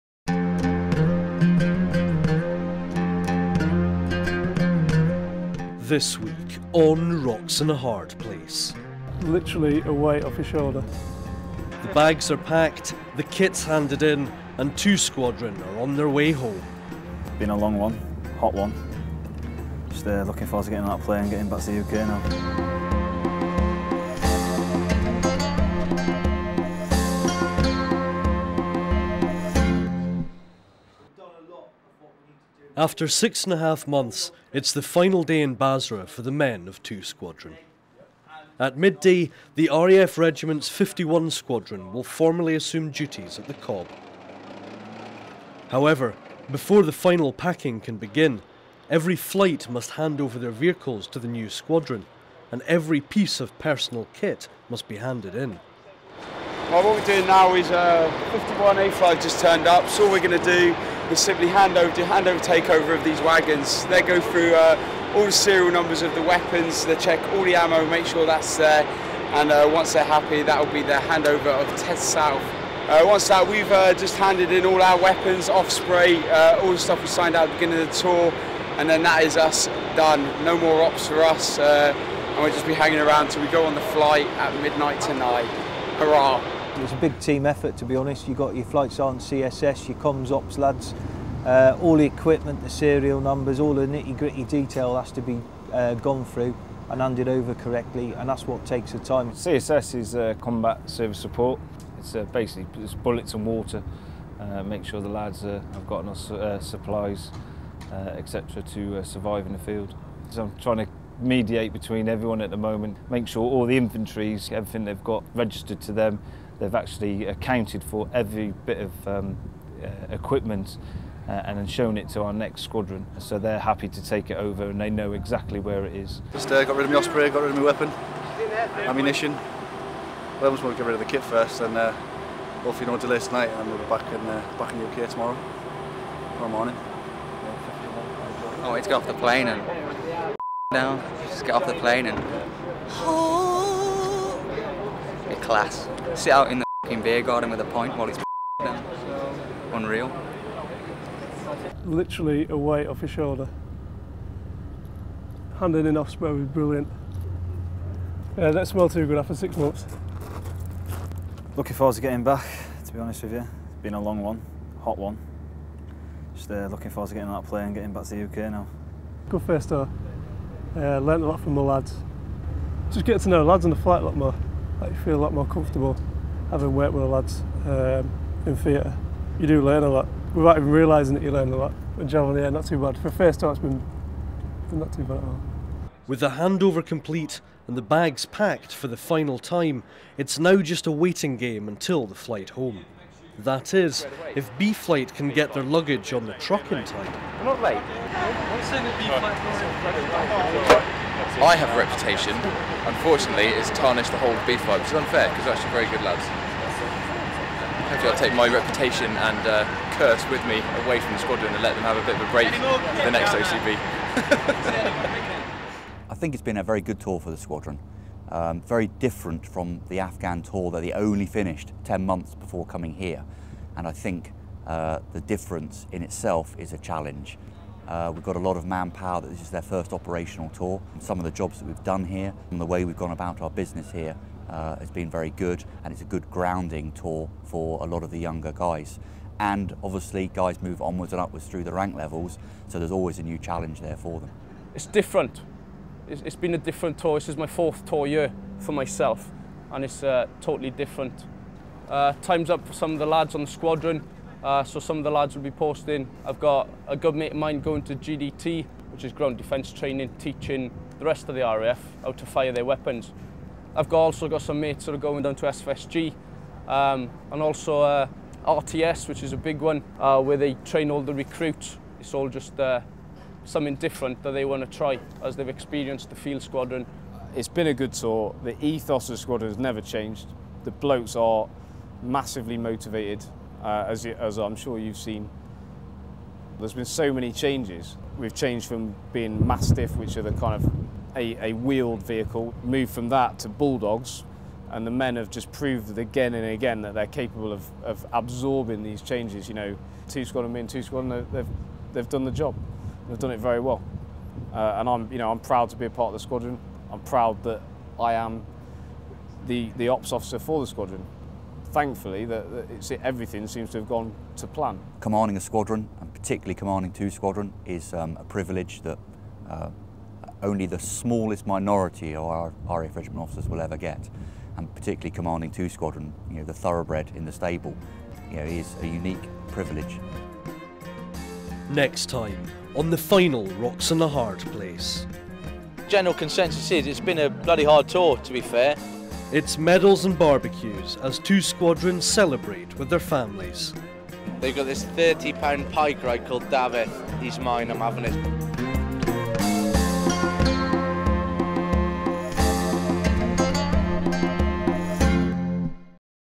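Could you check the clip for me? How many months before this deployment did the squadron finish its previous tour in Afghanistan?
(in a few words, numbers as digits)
10.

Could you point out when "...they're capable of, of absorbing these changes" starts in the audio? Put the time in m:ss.
4:56.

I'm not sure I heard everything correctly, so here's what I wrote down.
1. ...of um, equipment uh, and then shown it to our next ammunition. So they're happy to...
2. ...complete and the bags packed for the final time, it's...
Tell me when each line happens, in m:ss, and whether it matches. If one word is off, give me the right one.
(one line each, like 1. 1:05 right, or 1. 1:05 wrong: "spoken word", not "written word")
1. 1:58 wrong: "squadron", not "ammunition"
2. 3:06 right.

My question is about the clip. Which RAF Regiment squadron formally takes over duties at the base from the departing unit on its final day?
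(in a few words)
51 Squadron.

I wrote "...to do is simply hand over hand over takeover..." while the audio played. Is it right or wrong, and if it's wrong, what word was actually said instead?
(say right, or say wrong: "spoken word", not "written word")
right.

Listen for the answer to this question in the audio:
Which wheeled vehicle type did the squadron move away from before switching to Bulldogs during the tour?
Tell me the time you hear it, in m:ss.
4:49.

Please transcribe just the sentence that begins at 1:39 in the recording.
CSS is uh, combat service support.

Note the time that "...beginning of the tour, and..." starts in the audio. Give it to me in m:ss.
1:17.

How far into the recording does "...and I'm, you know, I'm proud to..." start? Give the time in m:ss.
5:04.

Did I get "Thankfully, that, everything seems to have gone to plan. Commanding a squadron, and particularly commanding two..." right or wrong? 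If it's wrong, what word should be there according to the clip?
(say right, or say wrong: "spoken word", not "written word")
right.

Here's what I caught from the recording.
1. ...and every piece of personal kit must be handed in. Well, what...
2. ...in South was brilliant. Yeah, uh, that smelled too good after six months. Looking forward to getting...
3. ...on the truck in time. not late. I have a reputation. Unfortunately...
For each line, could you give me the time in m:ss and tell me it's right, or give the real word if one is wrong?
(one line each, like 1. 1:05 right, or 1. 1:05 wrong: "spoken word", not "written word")
1. 0:52 right
2. 2:35 wrong: "Osprey", not "South"
3. 3:16 right.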